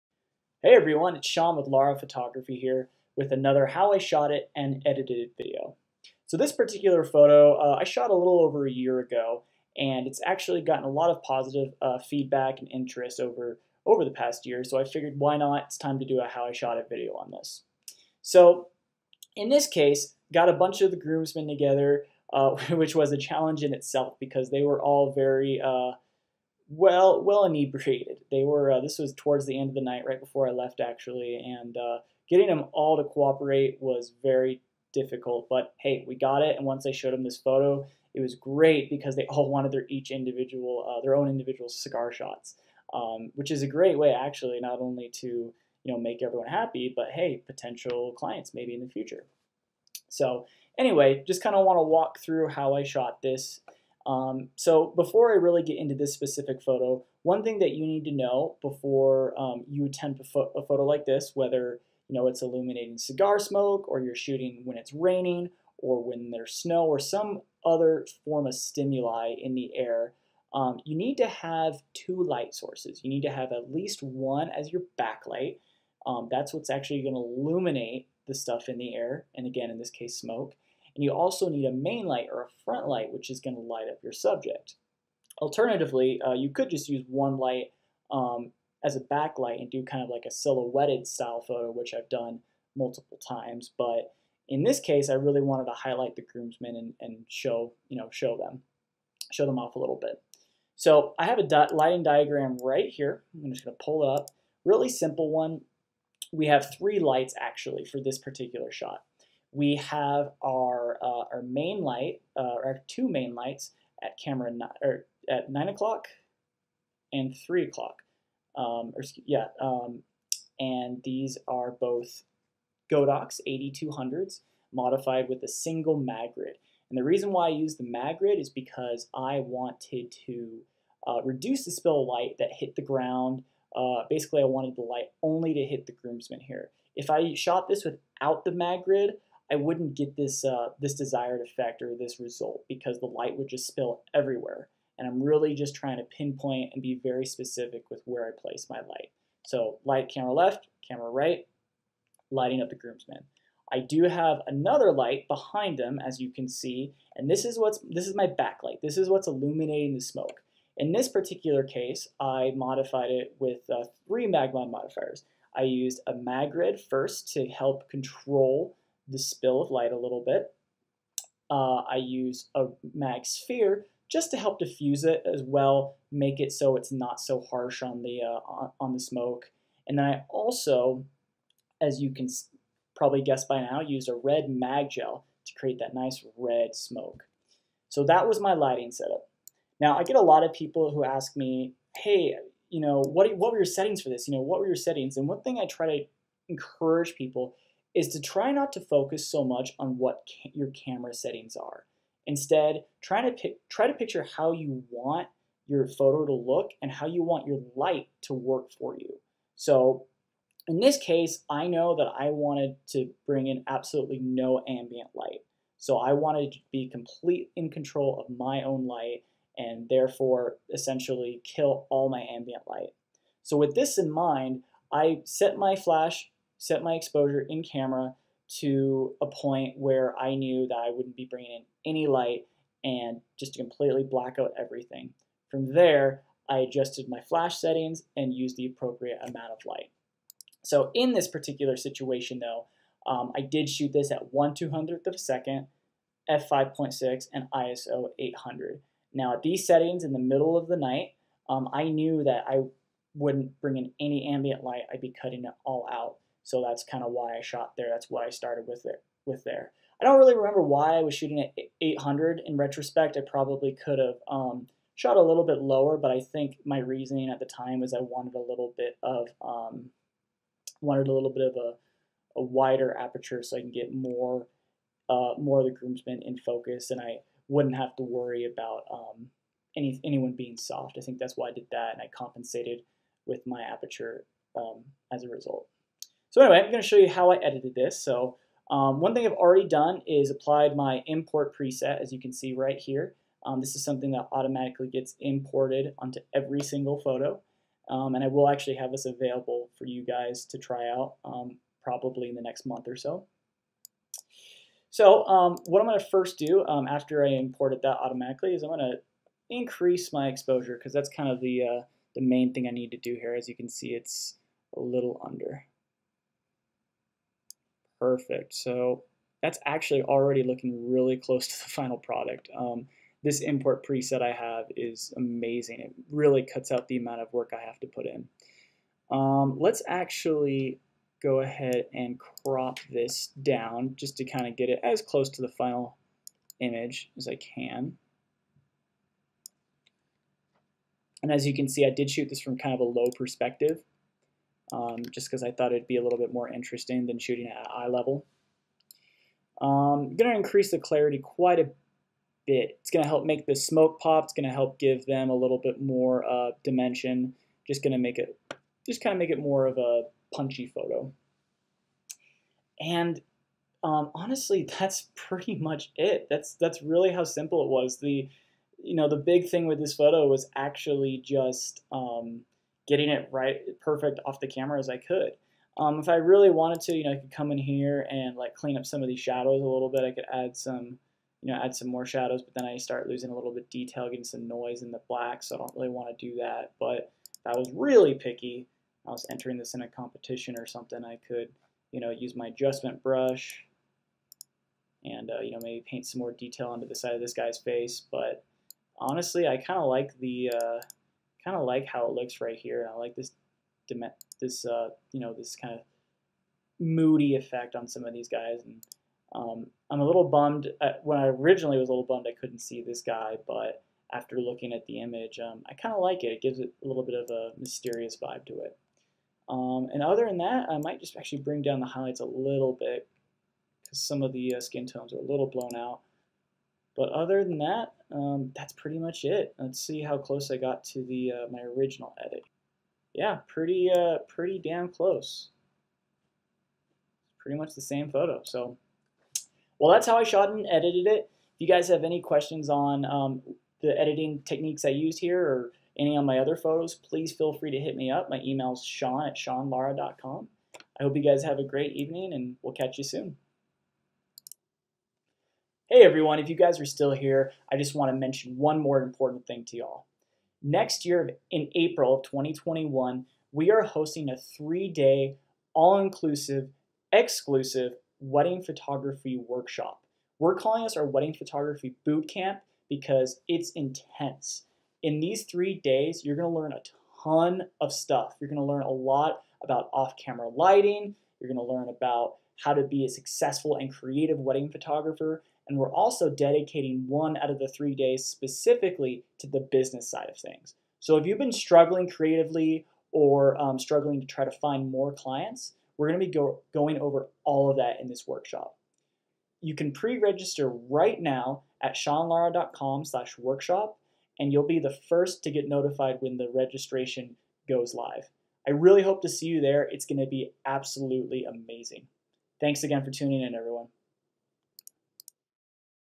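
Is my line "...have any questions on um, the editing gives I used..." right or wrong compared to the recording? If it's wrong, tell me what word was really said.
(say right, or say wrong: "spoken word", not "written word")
wrong: "techniques", not "gives".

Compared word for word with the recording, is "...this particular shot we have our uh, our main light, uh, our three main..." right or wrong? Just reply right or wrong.
wrong.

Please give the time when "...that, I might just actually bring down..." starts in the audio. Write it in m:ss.
7:00.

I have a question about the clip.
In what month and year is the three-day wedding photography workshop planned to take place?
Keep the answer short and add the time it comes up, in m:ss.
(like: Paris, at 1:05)
April 2021, at 7:41.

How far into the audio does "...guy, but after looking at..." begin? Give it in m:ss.
6:53.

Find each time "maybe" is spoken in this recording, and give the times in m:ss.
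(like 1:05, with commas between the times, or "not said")
0:48, 6:35.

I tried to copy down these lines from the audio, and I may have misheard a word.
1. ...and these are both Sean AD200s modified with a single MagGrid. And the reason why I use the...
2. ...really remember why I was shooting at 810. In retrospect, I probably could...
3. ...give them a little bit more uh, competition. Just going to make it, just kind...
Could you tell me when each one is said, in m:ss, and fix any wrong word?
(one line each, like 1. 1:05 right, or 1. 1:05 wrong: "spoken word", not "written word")
1. 2:00 wrong: "Godox", not "Sean"
2. 4:20 wrong: "800", not "810"
3. 5:54 wrong: "dimension", not "competition".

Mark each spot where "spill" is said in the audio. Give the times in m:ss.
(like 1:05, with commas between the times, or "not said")
2:11, 2:23, 2:49.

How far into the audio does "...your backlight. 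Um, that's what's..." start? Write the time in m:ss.
1:14.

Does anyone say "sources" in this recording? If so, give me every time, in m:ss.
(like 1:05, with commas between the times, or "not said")
1:12.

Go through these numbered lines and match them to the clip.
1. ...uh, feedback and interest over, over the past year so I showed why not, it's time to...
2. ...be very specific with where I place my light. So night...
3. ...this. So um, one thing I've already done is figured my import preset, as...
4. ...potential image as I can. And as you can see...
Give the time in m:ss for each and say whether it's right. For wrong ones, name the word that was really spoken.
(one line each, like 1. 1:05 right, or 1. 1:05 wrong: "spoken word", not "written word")
1. 0:11 wrong: "figured", not "showed"
2. 2:26 wrong: "light", not "night"
3. 4:47 wrong: "applied", not "figured"
4. 5:35 wrong: "final", not "potential".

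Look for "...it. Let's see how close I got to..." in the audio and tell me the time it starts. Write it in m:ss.
7:09.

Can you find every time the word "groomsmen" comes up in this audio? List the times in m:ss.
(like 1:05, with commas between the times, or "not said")
0:20, 1:36, 2:15, 2:32, 4:35.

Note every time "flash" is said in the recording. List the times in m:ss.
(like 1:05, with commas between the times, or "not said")
3:45, 3:57.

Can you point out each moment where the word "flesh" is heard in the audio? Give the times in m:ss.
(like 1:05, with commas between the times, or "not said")
not said.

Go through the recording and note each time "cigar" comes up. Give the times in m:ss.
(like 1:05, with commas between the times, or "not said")
0:41, 1:02.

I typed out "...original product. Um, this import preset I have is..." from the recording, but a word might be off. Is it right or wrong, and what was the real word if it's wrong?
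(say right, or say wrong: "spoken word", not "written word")
wrong: "final", not "original".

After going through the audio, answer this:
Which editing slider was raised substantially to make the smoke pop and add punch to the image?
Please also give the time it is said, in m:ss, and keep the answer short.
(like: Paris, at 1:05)
clarity, at 5:50.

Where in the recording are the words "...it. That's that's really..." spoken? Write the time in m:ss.
6:05.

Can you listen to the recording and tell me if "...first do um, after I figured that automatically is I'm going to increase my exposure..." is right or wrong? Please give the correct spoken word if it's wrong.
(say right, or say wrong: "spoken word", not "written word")
wrong: "imported", not "figured".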